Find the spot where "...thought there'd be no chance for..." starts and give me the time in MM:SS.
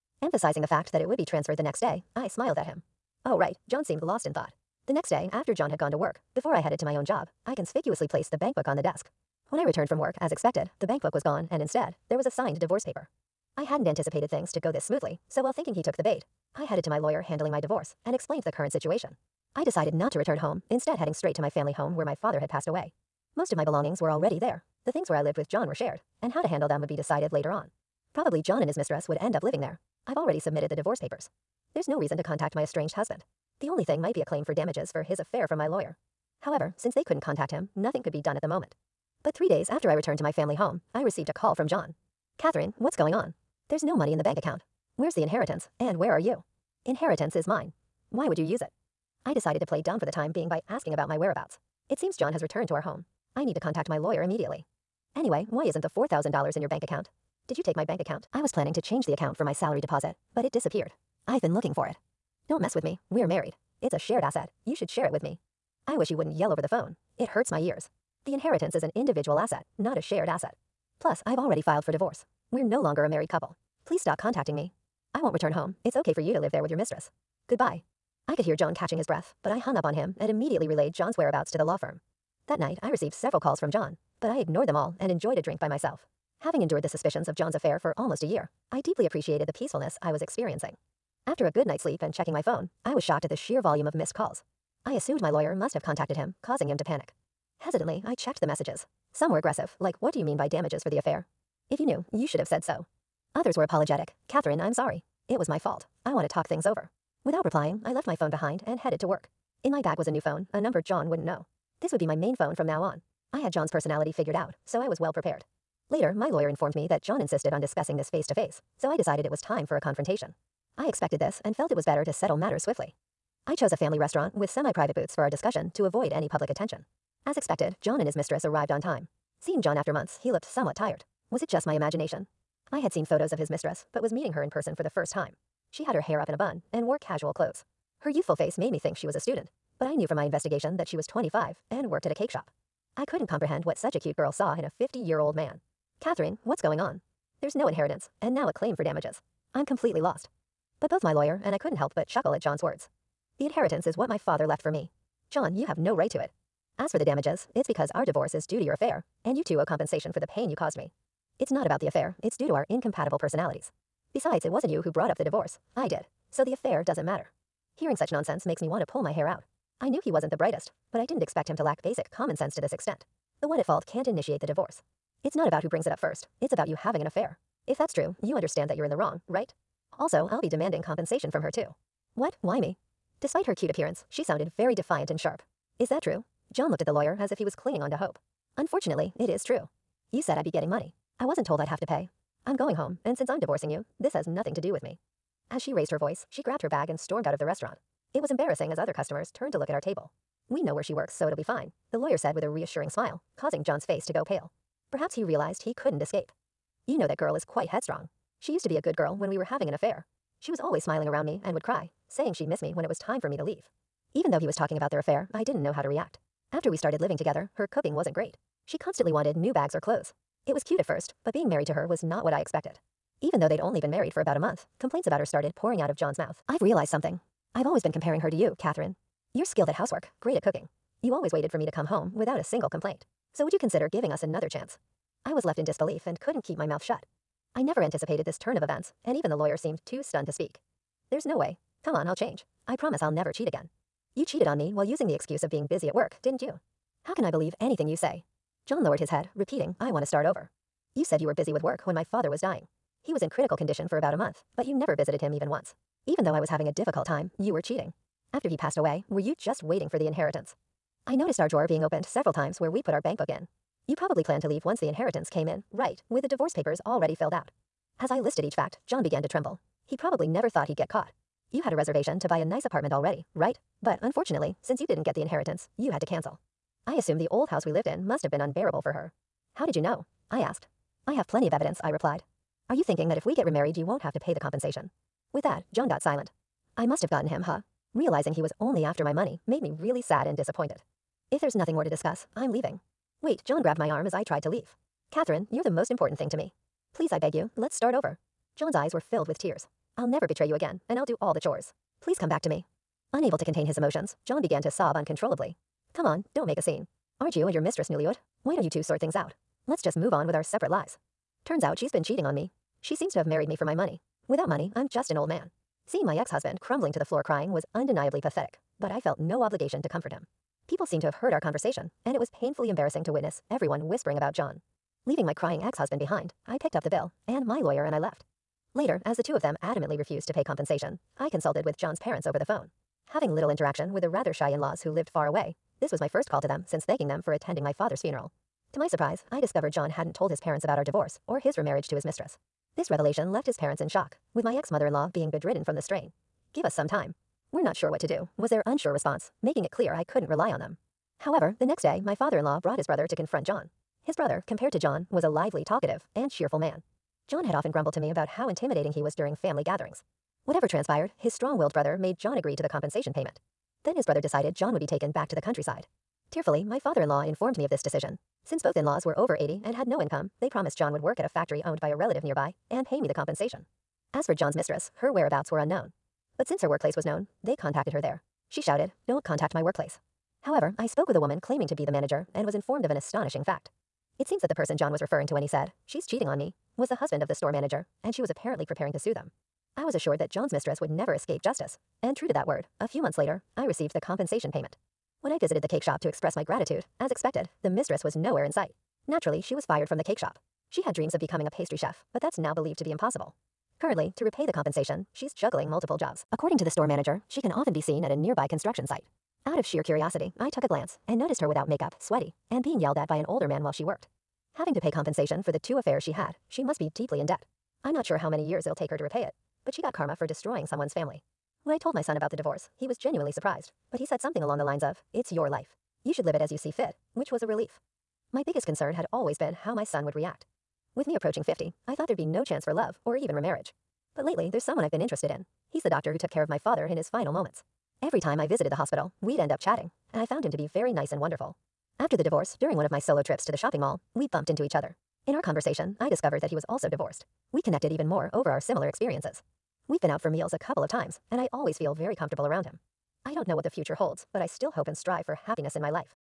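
07:11.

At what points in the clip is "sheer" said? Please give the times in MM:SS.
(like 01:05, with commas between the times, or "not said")
01:33, 06:49.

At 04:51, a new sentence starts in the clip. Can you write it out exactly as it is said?
If there's nothing more to discuss, I'm leaving.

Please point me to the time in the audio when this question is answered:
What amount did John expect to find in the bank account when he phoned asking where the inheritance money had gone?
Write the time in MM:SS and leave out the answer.
00:55.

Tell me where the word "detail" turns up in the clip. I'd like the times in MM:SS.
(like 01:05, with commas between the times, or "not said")
not said.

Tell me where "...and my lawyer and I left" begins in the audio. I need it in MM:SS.
05:27.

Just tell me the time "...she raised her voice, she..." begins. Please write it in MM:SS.
03:15.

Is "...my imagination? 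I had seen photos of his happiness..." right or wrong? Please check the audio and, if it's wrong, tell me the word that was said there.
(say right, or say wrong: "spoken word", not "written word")
wrong: "mistress", not "happiness".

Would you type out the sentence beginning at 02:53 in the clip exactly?
The one at fault can't initiate the divorce.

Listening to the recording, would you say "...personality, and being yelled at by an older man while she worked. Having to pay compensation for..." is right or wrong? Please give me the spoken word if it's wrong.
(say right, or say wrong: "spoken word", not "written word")
wrong: "sweaty", not "personality".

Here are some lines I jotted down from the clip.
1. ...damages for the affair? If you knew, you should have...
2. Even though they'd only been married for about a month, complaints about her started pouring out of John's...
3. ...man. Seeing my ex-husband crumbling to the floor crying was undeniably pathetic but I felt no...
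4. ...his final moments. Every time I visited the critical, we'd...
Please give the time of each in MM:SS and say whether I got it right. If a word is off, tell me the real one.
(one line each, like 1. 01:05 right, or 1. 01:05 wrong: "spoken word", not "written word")
1. 01:40 right
2. 03:43 right
3. 05:15 right
4. 07:16 wrong: "hospital", not "critical".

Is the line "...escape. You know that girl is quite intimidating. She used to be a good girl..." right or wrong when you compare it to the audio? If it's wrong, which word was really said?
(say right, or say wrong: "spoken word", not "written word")
wrong: "headstrong", not "intimidating".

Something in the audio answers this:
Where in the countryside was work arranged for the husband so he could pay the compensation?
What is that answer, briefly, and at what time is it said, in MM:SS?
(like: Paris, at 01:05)
Factory, at 06:11.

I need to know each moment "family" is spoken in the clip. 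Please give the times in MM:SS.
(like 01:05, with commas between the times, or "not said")
00:21, 00:40, 02:03, 05:59, 07:00.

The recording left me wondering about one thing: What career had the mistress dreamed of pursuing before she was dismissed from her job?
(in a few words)
Pastry chef.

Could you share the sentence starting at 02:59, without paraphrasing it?
Also, I'll be demanding compensation from her, too.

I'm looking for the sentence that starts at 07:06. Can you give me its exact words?
You should live it as you see fit, which was a relief.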